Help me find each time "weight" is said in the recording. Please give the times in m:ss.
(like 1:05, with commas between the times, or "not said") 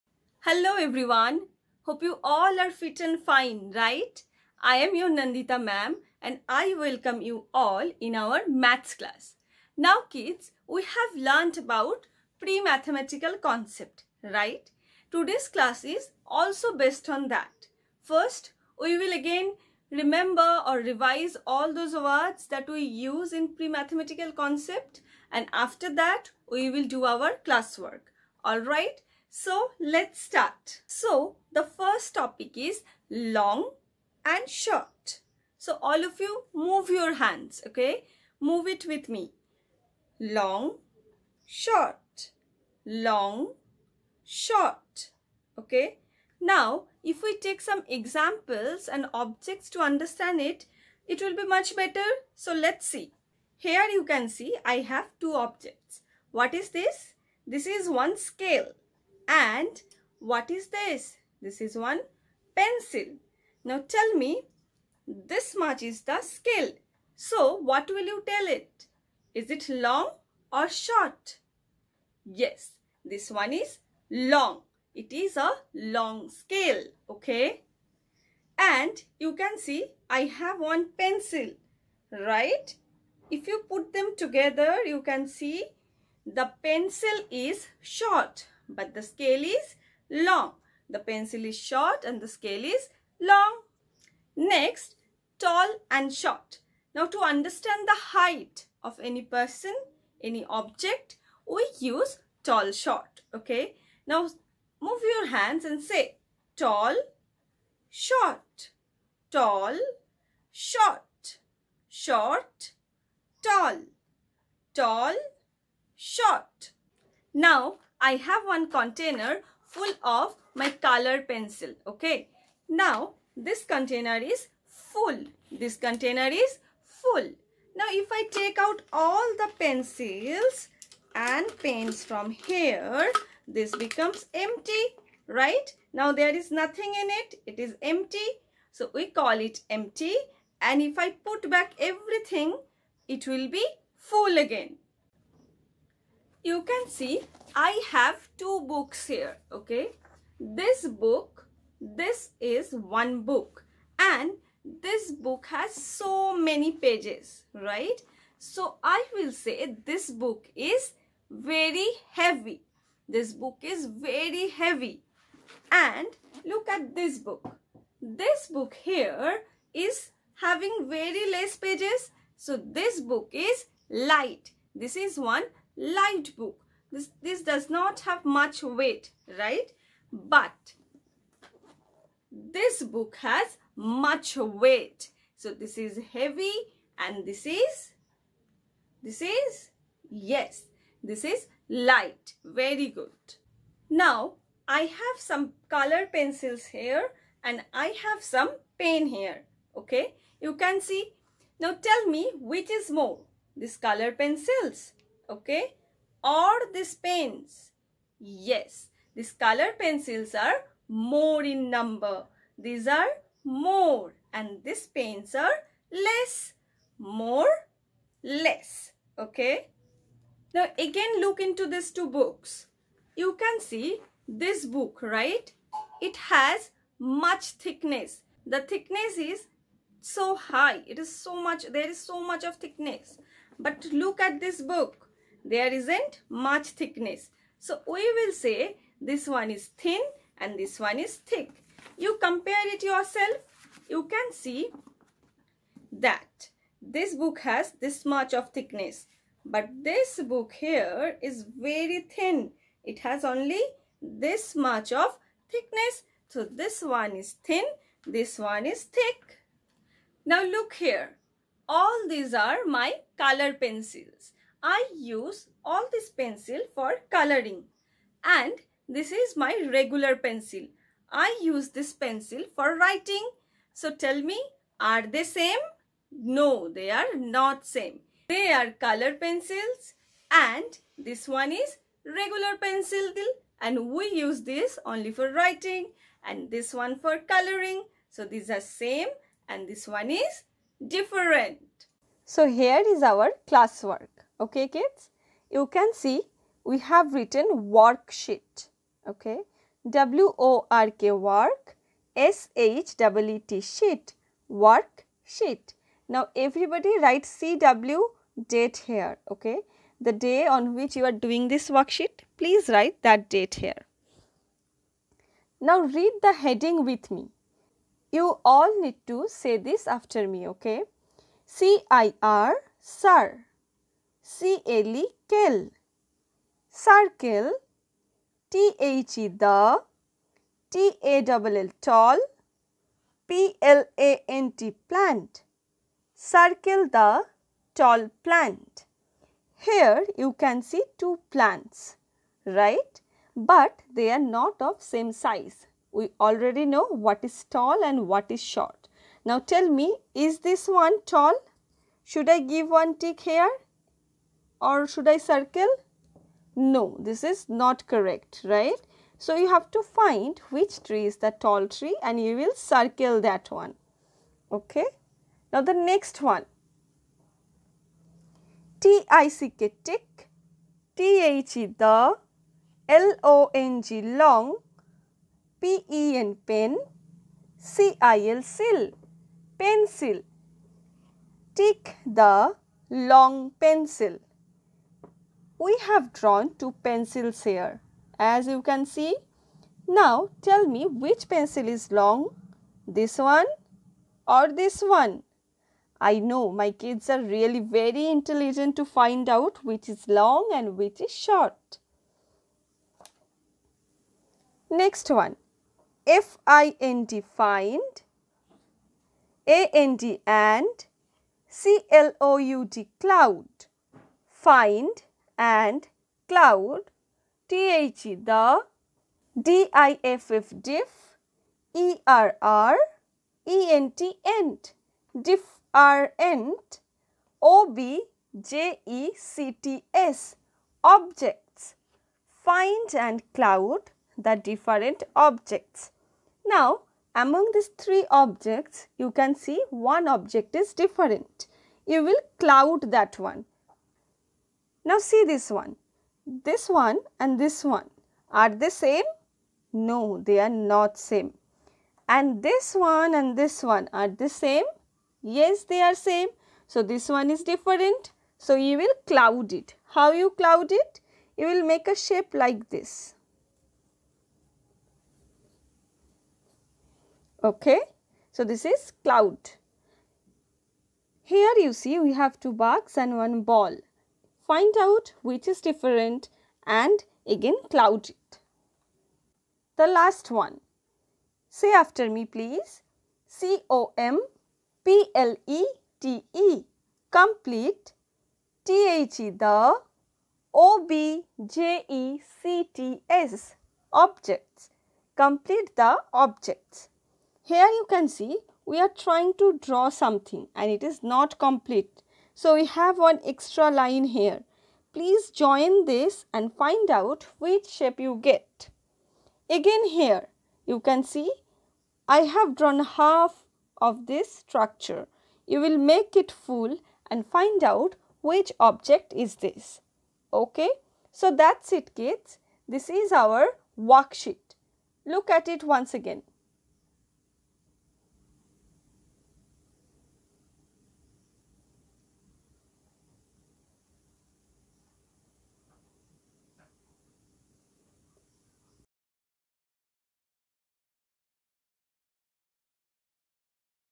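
2:58, 3:04.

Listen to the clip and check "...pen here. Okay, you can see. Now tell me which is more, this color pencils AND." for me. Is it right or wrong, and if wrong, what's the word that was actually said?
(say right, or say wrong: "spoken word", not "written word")
wrong: "Okay", not "AND".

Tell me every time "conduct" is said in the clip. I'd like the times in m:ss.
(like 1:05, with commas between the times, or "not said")
not said.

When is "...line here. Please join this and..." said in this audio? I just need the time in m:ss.
8:23.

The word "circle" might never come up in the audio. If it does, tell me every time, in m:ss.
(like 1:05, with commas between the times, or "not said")
5:26, 5:36, 5:55, 6:02.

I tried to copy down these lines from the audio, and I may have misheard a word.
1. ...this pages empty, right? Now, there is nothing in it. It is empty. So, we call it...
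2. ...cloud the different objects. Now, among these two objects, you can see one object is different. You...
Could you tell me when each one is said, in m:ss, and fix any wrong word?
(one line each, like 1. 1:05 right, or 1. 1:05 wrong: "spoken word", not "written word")
1. 2:13 wrong: "becomes", not "pages"
2. 7:13 wrong: "three", not "two".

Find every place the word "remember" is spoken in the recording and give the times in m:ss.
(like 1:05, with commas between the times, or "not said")
0:19.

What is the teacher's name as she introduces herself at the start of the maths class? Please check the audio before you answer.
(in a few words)
Nandita.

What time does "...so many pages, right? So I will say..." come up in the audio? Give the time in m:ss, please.
2:35.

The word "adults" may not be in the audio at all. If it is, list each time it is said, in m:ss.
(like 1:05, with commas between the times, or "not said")
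not said.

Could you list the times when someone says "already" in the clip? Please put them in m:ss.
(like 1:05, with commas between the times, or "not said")
5:46.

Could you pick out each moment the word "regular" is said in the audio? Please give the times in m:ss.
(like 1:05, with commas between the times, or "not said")
4:29, 4:42.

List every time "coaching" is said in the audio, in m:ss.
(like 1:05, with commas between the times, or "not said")
not said.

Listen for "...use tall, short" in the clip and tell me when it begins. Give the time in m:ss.
1:41.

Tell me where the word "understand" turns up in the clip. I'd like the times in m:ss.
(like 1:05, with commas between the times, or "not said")
0:49, 1:37.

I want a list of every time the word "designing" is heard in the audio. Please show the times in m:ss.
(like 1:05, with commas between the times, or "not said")
not said.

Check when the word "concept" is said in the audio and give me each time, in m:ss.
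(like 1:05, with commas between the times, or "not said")
0:13, 0:24.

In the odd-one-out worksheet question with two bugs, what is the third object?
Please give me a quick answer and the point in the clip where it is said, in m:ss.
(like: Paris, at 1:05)
Ball, at 7:53.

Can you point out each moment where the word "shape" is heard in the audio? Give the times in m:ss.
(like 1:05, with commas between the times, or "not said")
7:41, 8:27.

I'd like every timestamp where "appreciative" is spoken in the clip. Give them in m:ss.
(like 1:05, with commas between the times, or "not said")
not said.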